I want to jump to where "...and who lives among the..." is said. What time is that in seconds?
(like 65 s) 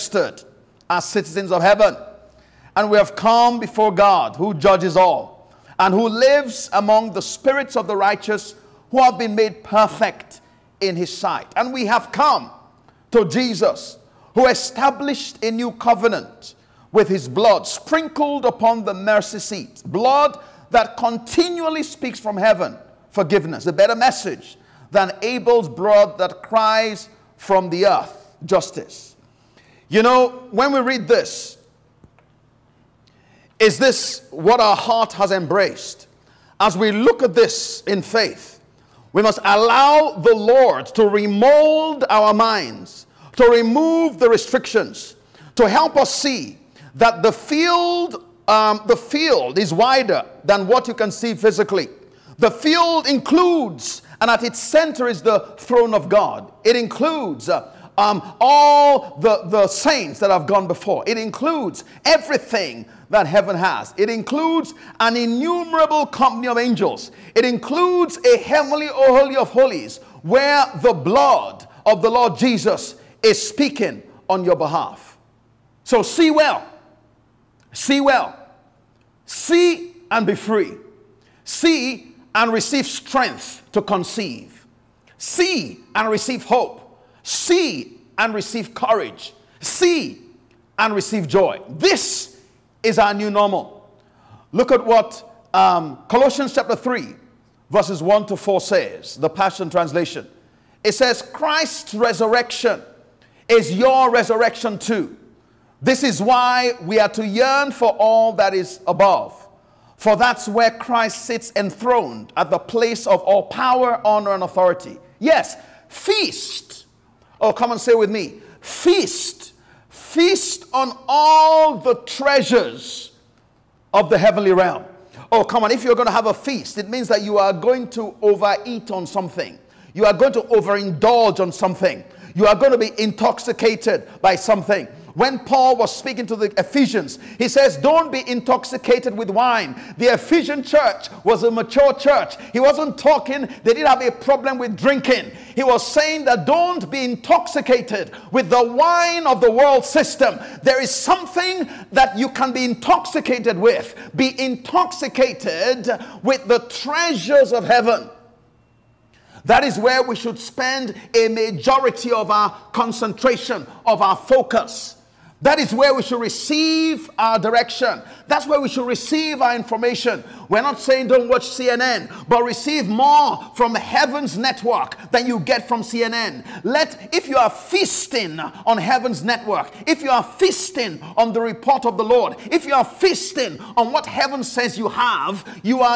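5 s.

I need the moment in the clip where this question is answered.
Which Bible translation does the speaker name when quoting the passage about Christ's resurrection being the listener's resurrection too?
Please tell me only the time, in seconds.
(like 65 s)
99 s.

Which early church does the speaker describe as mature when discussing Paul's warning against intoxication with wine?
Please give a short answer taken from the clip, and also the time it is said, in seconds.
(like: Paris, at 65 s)
Ephesian church, at 140 s.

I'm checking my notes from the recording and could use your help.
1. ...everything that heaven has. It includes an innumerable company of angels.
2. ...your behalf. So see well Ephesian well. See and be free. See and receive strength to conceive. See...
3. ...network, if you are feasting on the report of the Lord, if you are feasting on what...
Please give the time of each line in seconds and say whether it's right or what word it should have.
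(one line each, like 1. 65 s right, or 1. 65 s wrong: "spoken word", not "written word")
1. 62 s right
2. 74 s wrong: "See", not "Ephesian"
3. 179 s right.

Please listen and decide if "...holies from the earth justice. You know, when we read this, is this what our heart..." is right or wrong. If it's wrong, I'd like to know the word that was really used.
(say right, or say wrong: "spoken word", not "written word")
wrong: "cries", not "holies".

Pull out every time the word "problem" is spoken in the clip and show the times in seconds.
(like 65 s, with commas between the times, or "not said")
144 s.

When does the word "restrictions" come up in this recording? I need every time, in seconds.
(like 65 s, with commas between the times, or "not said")
44 s.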